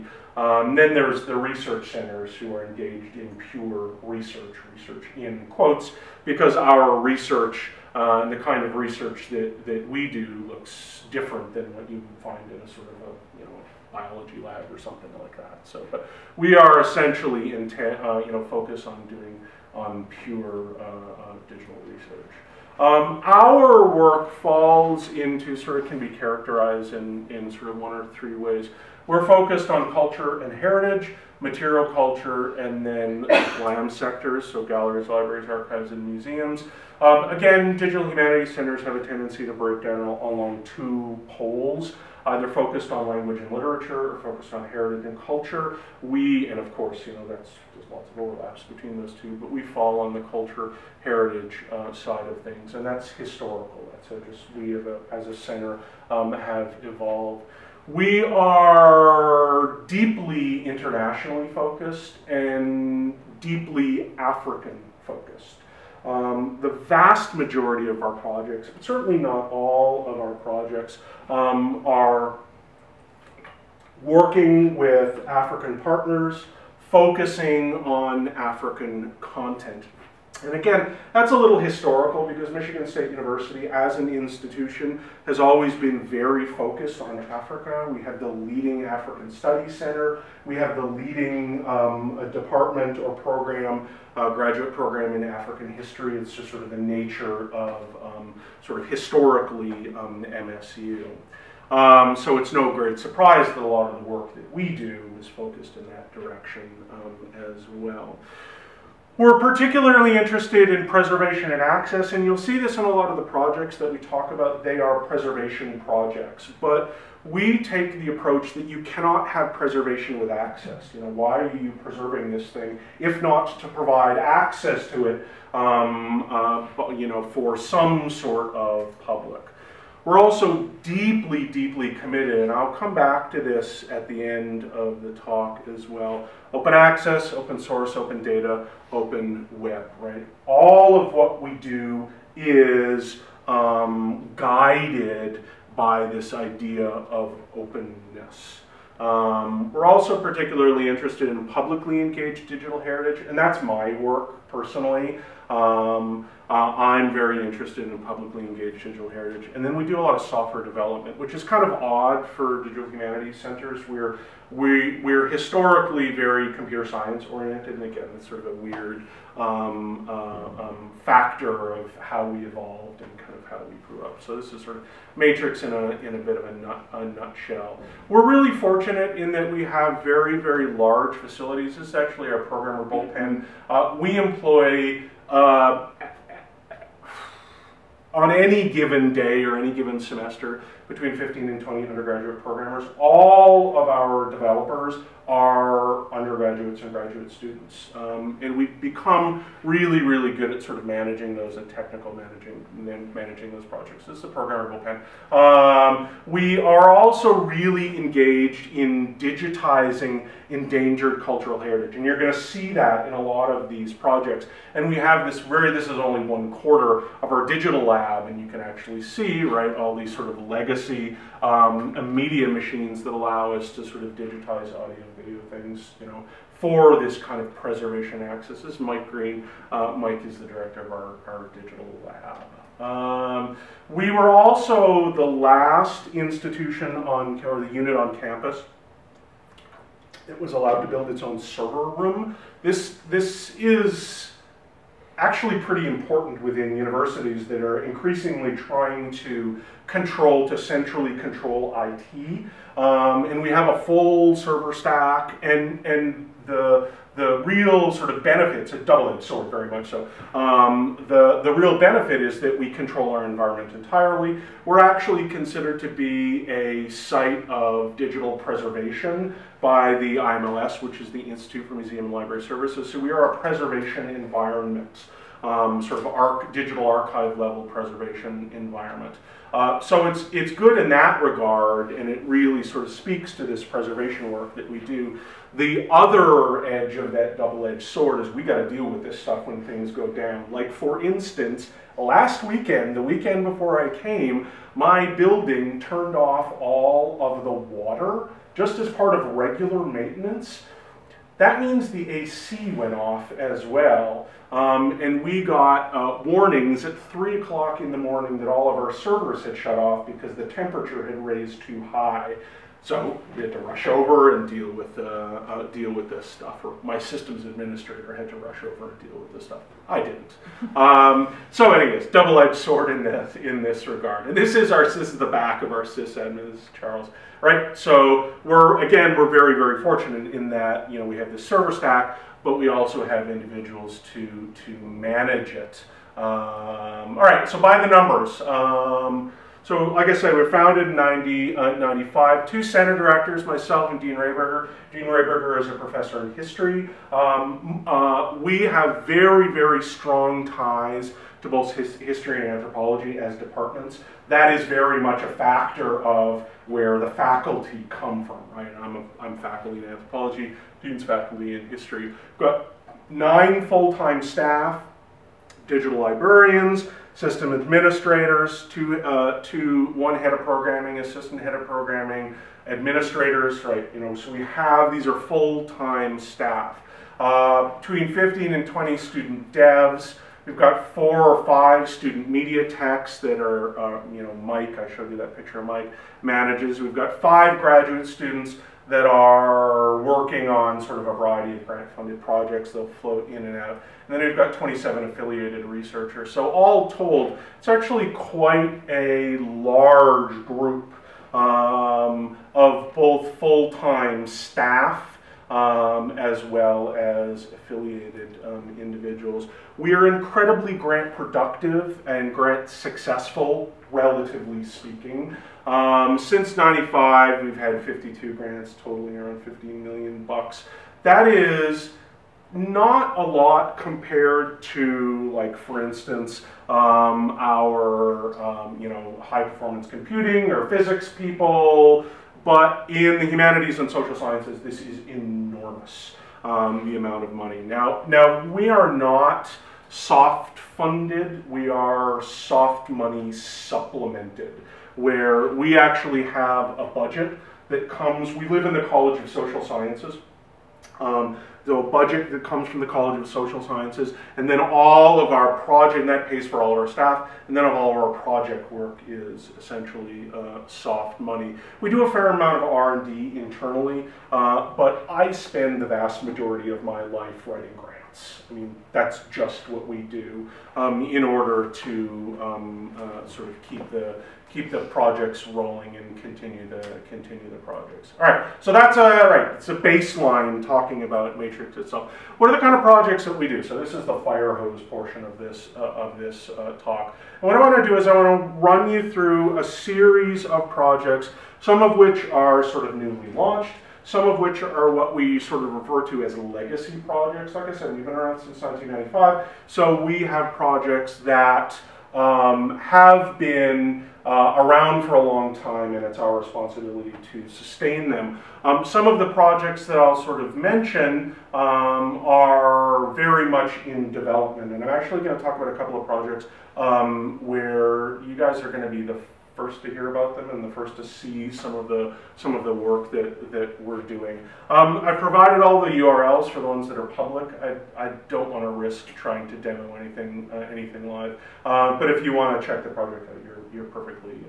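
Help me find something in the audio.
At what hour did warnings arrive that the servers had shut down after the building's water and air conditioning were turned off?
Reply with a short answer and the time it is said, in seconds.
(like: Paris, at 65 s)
3 o'clock in the morning, at 307 s.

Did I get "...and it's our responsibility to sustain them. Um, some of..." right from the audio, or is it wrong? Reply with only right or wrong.
right.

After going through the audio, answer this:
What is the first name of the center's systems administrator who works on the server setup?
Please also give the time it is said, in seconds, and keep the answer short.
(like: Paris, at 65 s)
Charles, at 326 s.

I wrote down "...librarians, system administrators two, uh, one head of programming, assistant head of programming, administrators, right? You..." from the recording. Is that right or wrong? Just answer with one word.
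right.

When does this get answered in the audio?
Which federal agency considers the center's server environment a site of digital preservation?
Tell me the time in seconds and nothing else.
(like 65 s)
271 s.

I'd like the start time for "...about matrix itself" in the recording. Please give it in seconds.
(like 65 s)
481 s.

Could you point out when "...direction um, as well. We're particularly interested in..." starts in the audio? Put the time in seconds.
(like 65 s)
106 s.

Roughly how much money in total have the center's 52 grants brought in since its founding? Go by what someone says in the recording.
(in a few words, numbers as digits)
15 million dollars.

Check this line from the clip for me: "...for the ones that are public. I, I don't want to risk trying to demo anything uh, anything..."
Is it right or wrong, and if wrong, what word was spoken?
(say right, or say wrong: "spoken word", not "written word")
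right.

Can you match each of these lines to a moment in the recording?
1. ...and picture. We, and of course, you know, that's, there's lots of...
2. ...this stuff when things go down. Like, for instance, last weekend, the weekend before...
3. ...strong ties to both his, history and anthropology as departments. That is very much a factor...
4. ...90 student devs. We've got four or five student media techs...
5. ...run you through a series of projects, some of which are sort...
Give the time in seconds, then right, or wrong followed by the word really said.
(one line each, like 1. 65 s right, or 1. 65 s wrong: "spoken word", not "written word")
1. 45 s wrong: "culture", not "picture"
2. 289 s right
3. 349 s right
4. 378 s wrong: "20", not "90"
5. 488 s right.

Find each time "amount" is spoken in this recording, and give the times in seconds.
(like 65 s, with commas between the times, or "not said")
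436 s, 462 s.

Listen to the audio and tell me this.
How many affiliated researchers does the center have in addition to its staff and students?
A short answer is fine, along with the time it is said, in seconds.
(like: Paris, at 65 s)
27, at 394 s.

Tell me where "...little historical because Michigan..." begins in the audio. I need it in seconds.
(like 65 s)
81 s.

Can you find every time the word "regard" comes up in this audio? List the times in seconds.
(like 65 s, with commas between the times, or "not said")
281 s, 323 s.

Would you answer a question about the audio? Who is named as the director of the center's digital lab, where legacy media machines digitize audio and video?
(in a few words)
Mike Green.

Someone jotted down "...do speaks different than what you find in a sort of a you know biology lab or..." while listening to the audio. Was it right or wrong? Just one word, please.
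wrong.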